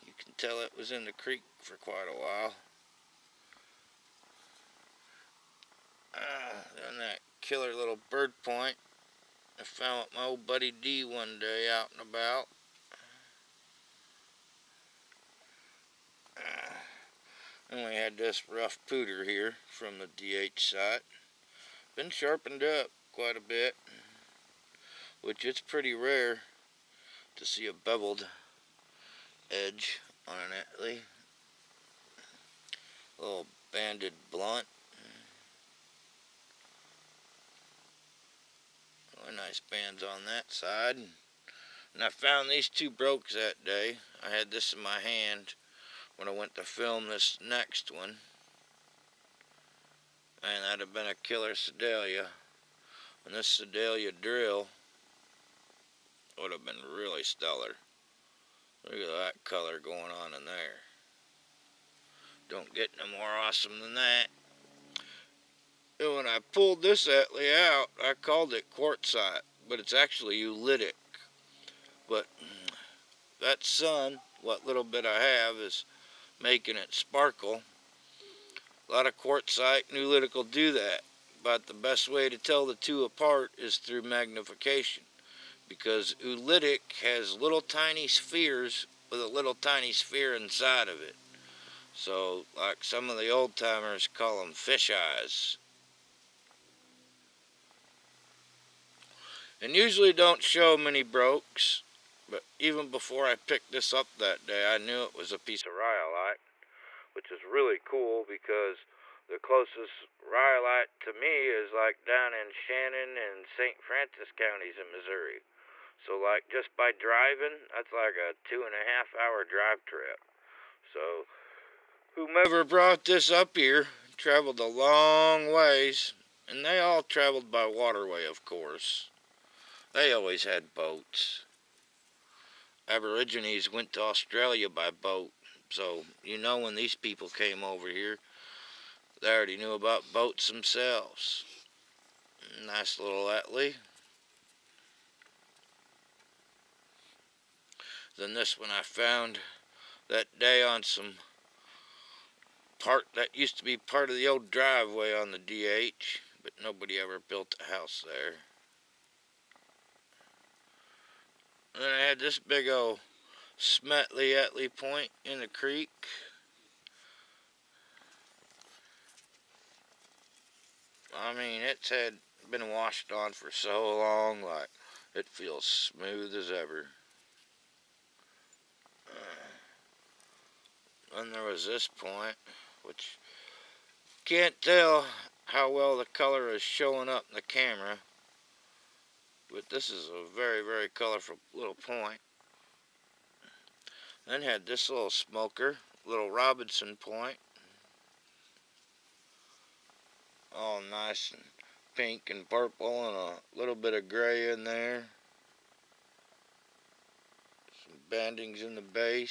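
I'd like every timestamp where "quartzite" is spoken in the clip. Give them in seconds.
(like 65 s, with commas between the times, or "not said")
68 s, 79 s.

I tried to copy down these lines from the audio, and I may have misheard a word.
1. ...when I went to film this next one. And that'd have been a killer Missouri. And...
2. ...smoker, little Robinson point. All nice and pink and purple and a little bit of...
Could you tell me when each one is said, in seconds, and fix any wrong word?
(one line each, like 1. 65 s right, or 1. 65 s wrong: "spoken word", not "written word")
1. 46 s wrong: "Sedalia", not "Missouri"
2. 195 s right.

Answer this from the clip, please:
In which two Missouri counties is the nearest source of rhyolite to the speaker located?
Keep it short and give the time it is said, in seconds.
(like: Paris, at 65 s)
Shannon and St. Francis, at 112 s.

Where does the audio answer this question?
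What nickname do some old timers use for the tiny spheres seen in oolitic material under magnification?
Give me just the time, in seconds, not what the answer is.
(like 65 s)
94 s.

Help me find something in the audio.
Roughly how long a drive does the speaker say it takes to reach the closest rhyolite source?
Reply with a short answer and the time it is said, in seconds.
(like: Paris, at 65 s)
2.5 hours, at 118 s.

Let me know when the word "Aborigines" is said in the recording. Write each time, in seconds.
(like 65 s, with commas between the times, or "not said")
132 s.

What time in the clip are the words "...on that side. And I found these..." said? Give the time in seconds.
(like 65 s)
40 s.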